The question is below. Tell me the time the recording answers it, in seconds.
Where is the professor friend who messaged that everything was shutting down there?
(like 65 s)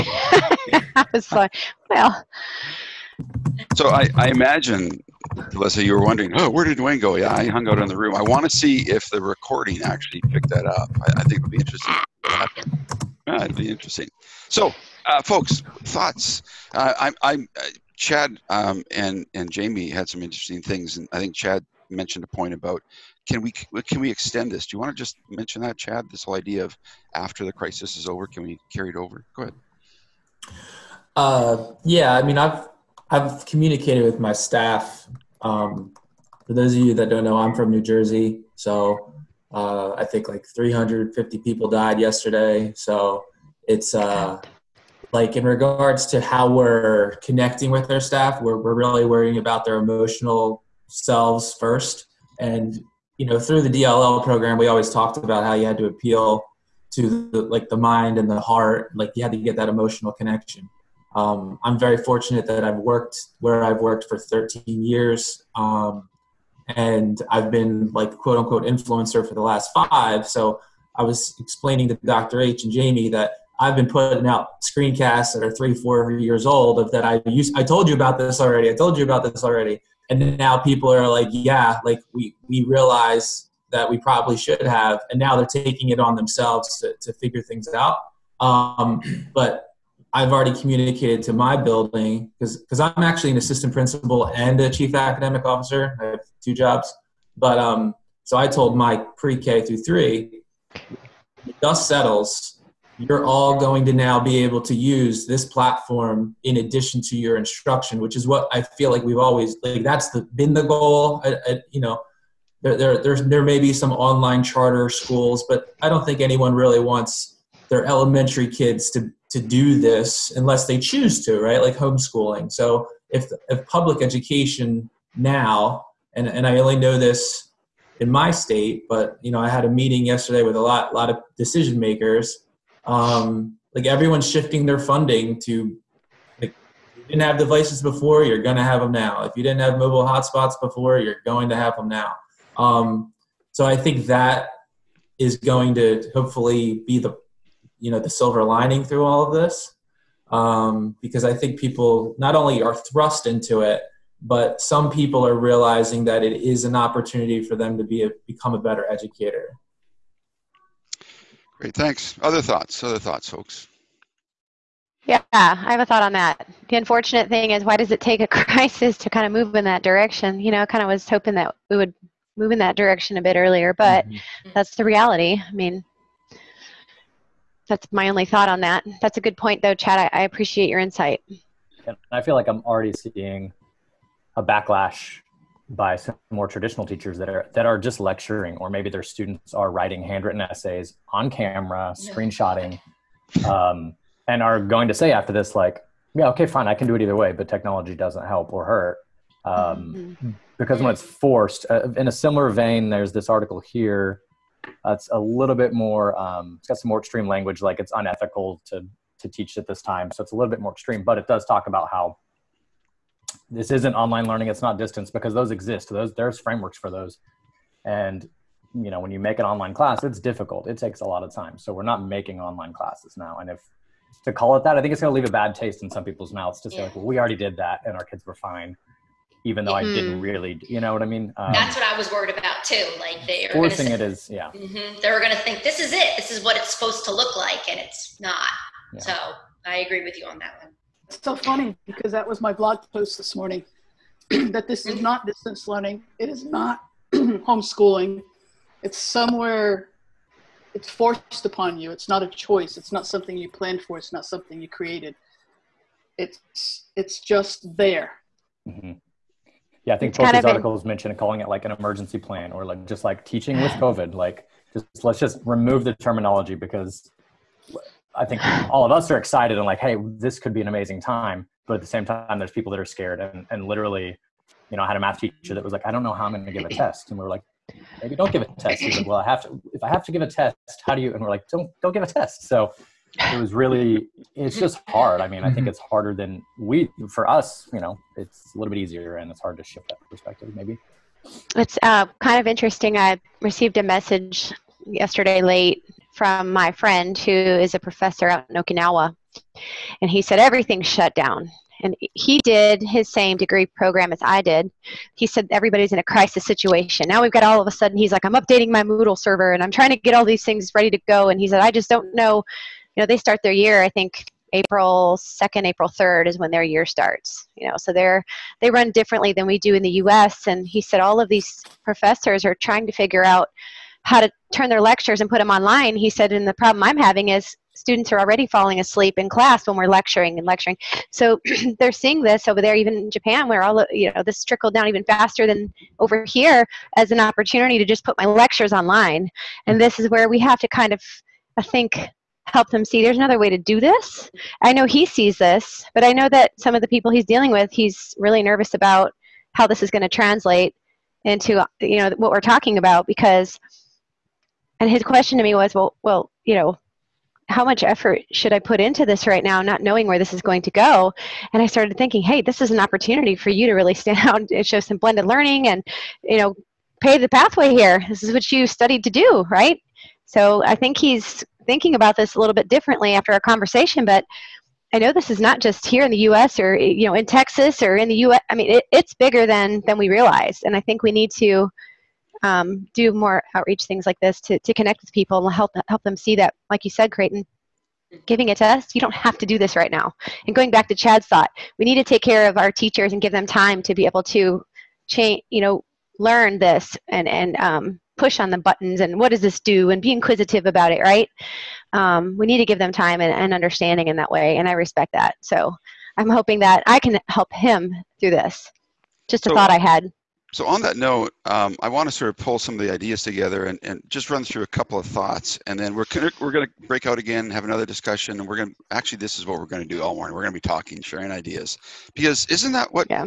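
298 s.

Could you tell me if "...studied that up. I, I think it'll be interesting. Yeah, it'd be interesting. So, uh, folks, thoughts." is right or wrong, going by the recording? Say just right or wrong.
wrong.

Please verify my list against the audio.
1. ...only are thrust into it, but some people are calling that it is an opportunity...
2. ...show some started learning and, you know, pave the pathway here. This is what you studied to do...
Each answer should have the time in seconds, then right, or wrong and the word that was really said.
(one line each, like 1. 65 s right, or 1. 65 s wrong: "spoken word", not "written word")
1. 152 s wrong: "realizing", not "calling"
2. 364 s wrong: "blended", not "started".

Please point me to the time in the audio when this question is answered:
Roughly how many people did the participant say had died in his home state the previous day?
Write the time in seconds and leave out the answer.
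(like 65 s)
40 s.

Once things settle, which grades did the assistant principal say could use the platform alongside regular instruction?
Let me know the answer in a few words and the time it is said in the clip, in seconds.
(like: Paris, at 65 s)
pre-k through three, at 99 s.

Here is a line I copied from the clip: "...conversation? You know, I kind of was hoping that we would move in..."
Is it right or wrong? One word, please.
wrong.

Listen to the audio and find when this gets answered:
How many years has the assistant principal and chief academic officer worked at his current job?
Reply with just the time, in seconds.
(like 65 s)
64 s.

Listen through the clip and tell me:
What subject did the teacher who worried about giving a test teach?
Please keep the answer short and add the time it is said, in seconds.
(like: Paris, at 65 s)
math, at 274 s.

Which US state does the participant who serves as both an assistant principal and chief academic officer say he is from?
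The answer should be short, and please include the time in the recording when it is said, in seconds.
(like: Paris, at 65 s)
New Jersey, at 37 s.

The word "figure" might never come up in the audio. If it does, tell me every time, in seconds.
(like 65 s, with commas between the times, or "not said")
87 s, 322 s.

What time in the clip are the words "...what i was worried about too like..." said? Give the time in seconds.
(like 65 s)
231 s.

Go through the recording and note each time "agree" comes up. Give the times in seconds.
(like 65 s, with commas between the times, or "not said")
239 s.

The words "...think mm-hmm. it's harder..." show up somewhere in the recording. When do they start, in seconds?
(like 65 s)
285 s.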